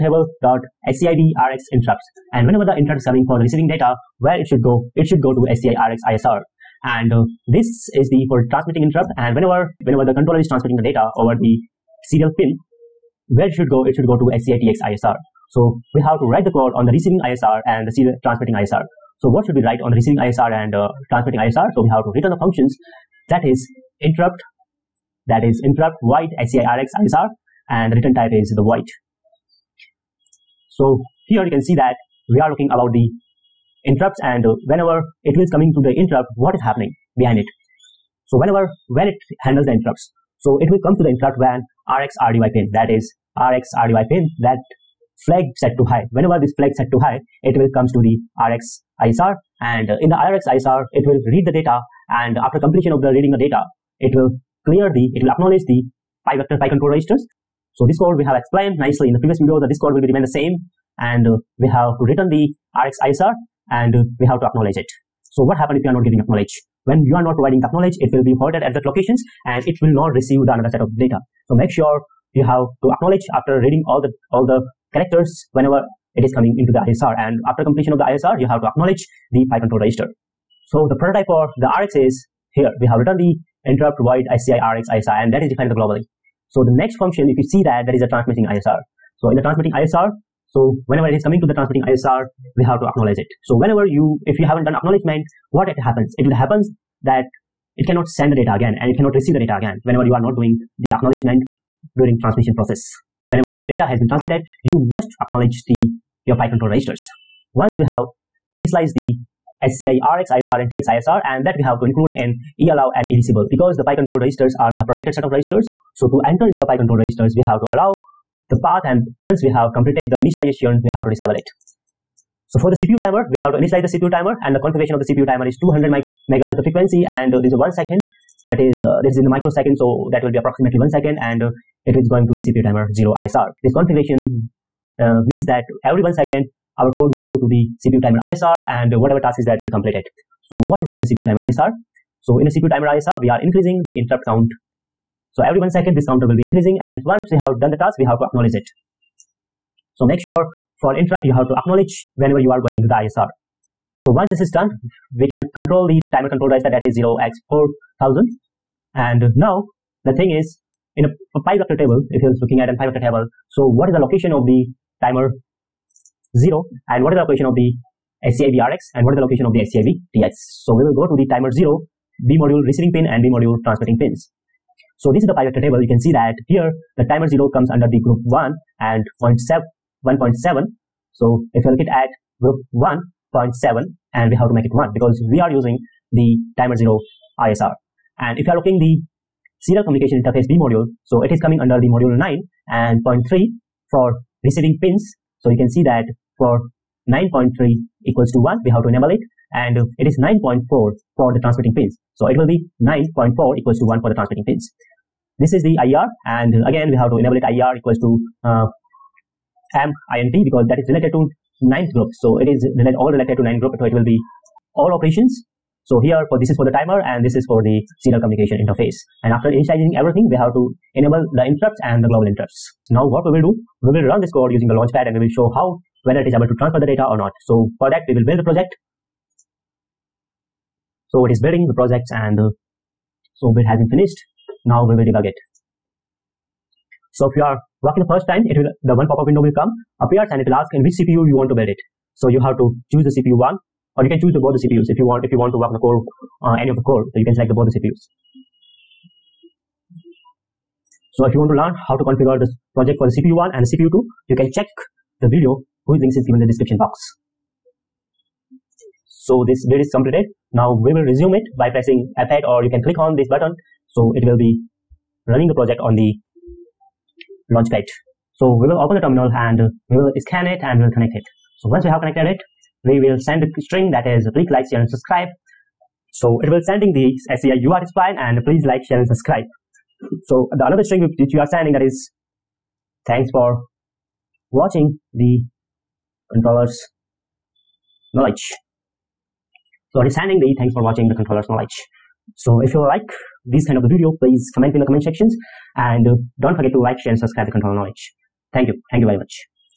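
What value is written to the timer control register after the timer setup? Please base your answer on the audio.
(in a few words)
0x4000.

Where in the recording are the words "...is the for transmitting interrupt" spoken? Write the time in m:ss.
0:07.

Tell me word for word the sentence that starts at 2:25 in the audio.
So every one second, this counter will be increasing.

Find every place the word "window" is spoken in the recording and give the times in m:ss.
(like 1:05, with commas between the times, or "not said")
3:59.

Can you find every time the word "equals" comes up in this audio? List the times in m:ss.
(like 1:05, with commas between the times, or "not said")
3:18, 3:23, 3:27.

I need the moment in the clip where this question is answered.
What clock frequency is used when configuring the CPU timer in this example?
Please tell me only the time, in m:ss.
2:05.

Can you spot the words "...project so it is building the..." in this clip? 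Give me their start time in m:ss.
3:48.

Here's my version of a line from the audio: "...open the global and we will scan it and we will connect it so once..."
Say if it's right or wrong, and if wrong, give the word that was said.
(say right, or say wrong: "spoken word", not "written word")
wrong: "terminal", not "global".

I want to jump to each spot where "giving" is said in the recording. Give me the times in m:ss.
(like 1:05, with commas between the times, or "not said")
1:06.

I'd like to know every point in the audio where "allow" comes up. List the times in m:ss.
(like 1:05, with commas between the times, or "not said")
1:52, 1:57.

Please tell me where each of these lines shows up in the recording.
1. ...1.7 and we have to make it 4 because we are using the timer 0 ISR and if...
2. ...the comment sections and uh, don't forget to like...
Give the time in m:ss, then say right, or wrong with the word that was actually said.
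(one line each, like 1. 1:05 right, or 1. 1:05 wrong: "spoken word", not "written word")
1. 3:02 wrong: "1", not "4"
2. 4:54 right.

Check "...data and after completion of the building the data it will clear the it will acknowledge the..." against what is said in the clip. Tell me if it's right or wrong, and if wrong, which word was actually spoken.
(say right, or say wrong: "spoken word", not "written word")
wrong: "reading", not "building".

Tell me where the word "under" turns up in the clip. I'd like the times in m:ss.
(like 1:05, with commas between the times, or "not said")
2:57, 3:11.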